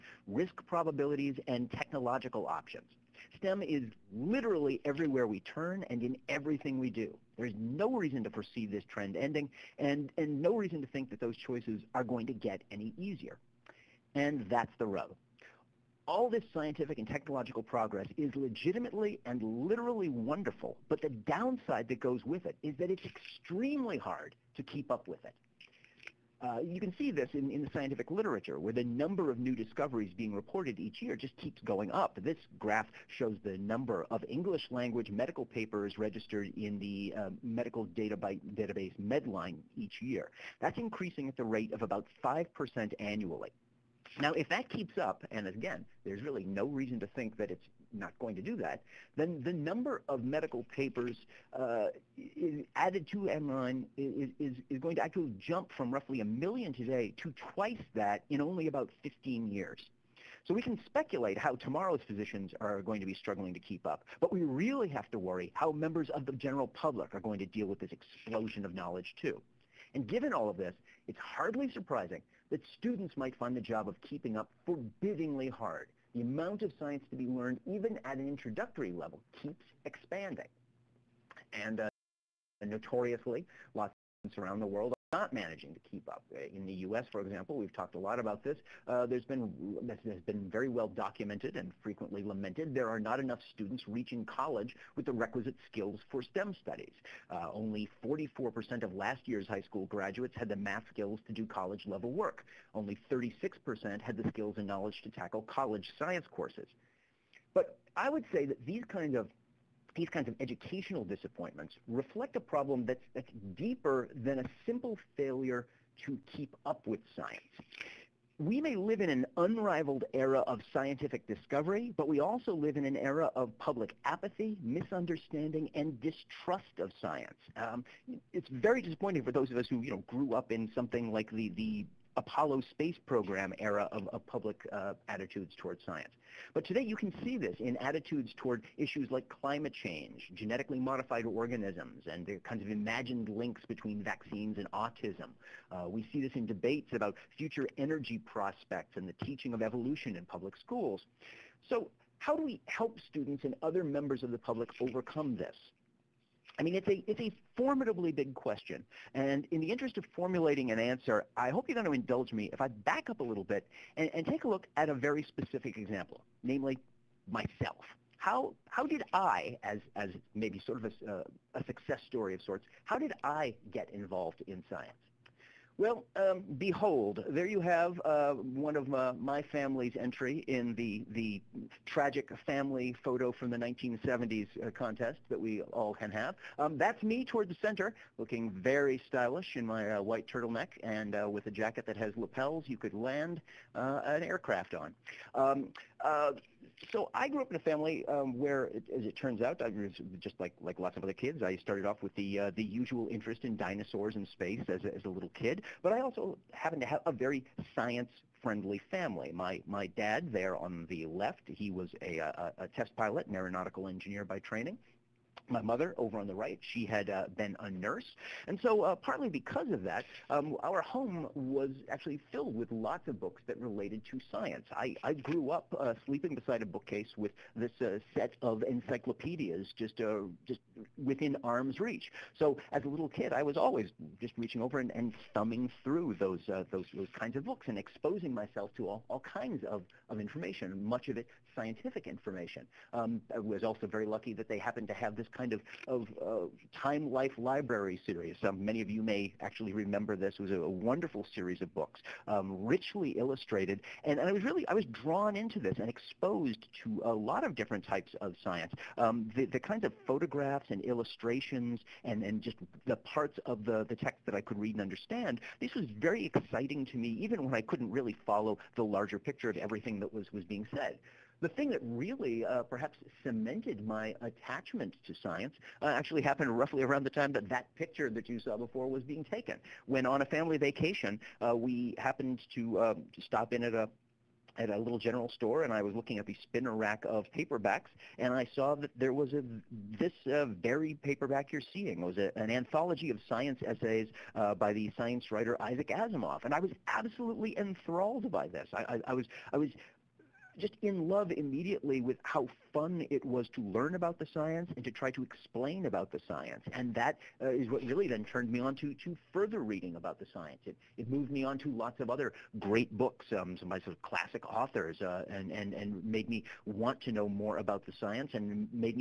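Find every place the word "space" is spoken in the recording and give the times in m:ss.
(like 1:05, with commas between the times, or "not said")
2:12, 3:24.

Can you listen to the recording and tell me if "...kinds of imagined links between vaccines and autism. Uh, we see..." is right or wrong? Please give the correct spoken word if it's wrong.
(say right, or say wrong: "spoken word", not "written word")
right.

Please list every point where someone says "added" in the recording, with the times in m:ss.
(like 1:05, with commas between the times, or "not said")
0:52.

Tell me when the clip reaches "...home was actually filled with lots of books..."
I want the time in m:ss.
3:40.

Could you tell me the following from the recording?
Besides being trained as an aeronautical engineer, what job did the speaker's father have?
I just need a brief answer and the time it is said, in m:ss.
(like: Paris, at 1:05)
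test pilot, at 3:32.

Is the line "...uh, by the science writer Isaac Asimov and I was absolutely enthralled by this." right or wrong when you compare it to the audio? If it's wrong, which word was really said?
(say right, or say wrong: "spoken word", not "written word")
right.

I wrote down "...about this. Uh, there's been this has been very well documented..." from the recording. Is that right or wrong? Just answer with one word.
right.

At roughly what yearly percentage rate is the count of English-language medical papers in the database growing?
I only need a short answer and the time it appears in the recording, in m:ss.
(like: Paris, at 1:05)
5%, at 0:42.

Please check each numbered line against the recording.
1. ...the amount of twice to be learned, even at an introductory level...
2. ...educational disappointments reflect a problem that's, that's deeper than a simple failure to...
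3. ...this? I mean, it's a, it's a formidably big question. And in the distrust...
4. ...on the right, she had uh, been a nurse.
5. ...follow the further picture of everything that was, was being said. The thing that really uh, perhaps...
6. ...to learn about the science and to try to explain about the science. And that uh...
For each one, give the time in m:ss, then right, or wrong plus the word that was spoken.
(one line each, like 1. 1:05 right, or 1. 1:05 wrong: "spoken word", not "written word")
1. 1:16 wrong: "science", not "twice"
2. 1:50 right
3. 2:35 wrong: "interest", not "distrust"
4. 3:36 right
5. 4:28 wrong: "larger", not "further"
6. 5:03 right.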